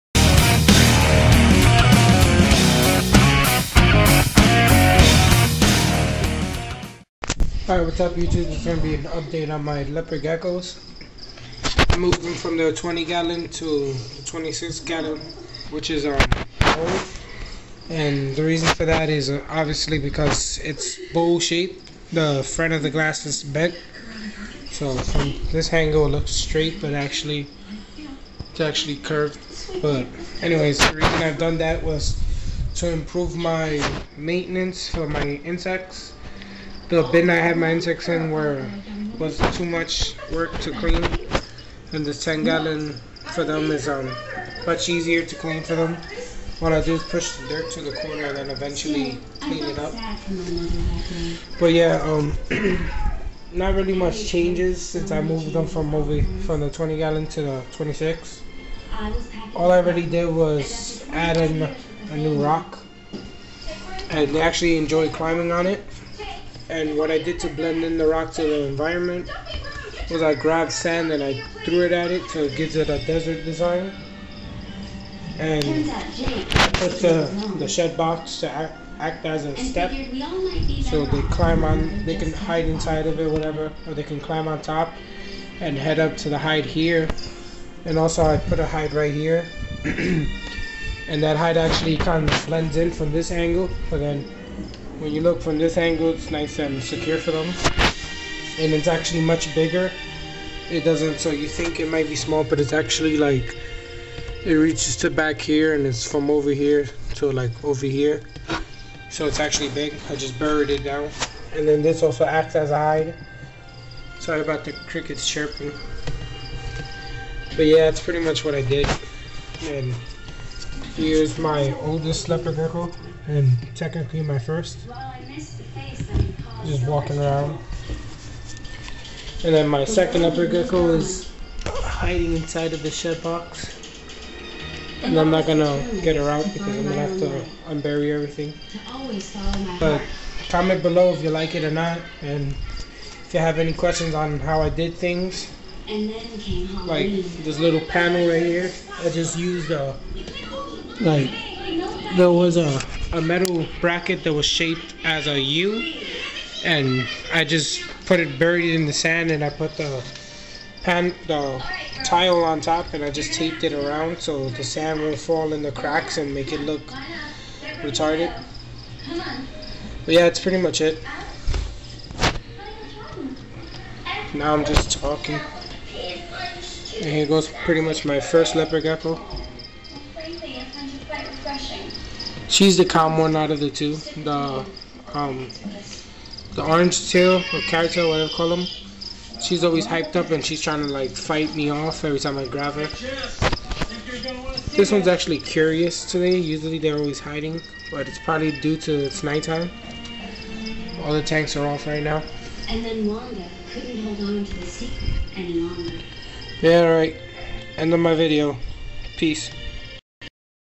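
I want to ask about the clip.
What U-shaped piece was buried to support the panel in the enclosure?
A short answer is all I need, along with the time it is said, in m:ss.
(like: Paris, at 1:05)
metal bracket, at 2:33.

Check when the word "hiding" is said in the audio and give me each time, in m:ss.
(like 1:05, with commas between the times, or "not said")
2:11, 3:17.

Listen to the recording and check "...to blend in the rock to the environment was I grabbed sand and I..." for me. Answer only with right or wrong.
right.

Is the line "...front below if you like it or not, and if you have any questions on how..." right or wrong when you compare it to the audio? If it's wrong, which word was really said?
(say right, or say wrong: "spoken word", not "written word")
wrong: "comment", not "front".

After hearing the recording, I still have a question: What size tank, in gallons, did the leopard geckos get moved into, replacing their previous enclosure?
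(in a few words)
26 gallon.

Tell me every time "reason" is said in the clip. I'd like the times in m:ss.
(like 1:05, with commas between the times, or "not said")
0:18, 0:30.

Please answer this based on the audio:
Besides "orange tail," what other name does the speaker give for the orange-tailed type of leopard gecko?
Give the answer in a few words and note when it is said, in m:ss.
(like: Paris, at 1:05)
carrot tail, at 3:07.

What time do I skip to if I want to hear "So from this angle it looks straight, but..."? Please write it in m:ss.
0:24.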